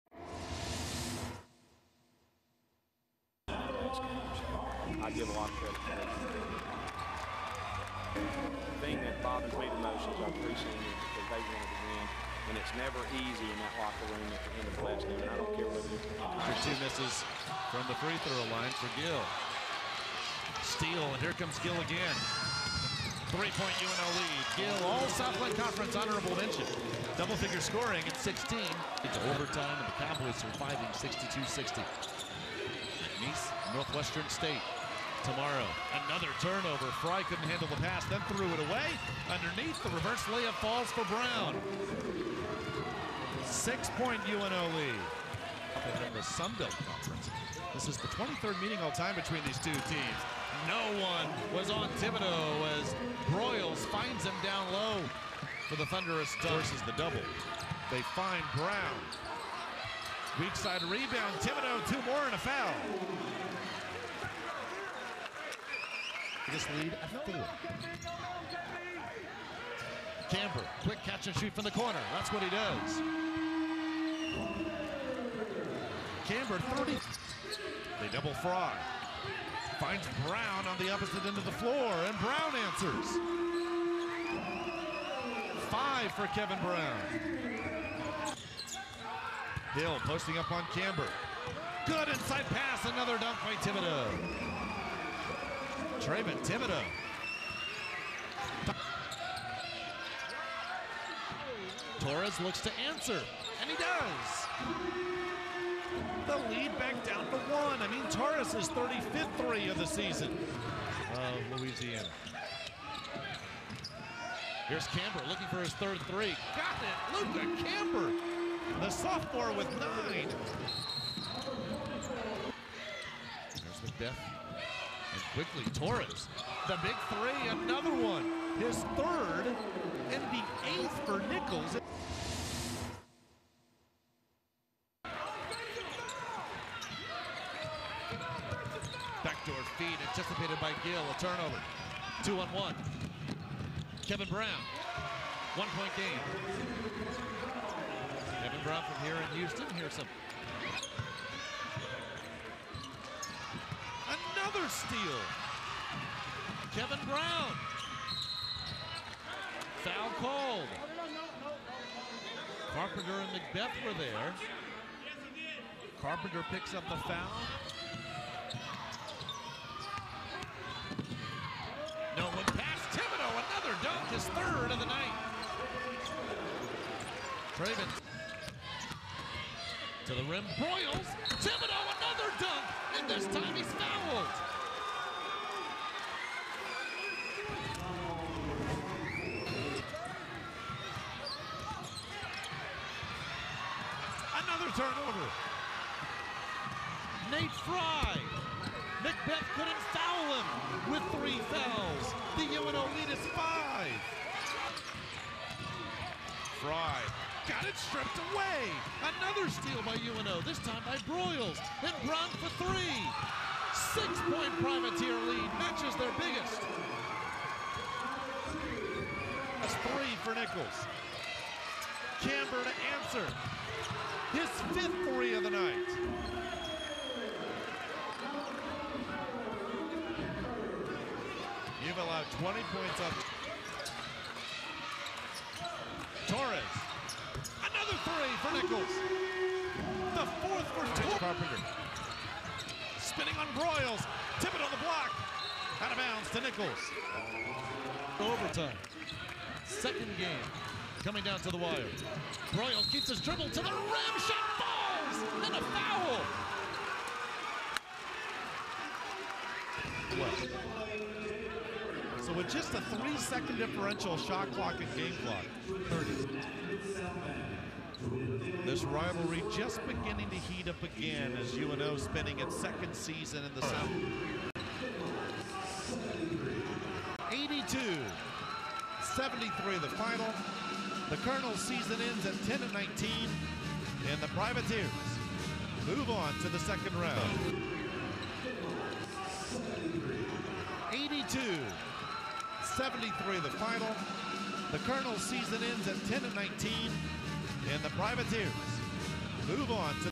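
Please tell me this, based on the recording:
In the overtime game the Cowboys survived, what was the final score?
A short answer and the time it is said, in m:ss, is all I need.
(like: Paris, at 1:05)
62-60, at 0:30.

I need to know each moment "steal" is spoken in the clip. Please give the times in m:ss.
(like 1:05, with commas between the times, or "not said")
0:20, 2:34, 3:29.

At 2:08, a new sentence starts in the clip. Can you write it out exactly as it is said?
His third and the eighth for Nicholls.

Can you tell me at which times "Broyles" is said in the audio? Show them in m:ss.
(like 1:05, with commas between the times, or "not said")
0:53, 3:31, 4:03, 4:12.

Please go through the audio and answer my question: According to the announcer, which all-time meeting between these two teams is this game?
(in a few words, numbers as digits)
23rd.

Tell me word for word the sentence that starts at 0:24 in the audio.
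Gill, all Southland Conference honorable mention.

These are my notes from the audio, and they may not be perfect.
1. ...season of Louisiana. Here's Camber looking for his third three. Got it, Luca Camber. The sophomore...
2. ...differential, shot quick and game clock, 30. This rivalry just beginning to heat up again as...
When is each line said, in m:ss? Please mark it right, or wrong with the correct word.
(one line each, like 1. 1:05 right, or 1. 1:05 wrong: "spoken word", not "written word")
1. 1:49 right
2. 4:23 wrong: "clock", not "quick".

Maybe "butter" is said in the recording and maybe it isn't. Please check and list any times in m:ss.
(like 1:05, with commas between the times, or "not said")
not said.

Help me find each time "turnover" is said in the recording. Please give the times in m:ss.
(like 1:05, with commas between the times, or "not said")
0:36, 2:21, 3:14.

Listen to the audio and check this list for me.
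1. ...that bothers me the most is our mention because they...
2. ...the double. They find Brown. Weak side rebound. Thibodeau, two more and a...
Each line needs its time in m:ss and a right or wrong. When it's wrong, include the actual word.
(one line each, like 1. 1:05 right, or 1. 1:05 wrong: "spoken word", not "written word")
1. 0:09 wrong: "preseason", not "mention"
2. 0:56 right.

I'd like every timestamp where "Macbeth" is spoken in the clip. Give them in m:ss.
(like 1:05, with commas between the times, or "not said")
2:03, 2:43, 3:19.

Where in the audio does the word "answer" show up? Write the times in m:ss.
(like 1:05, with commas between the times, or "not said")
1:22, 1:42, 3:42.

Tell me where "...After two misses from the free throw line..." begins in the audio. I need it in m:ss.
0:16.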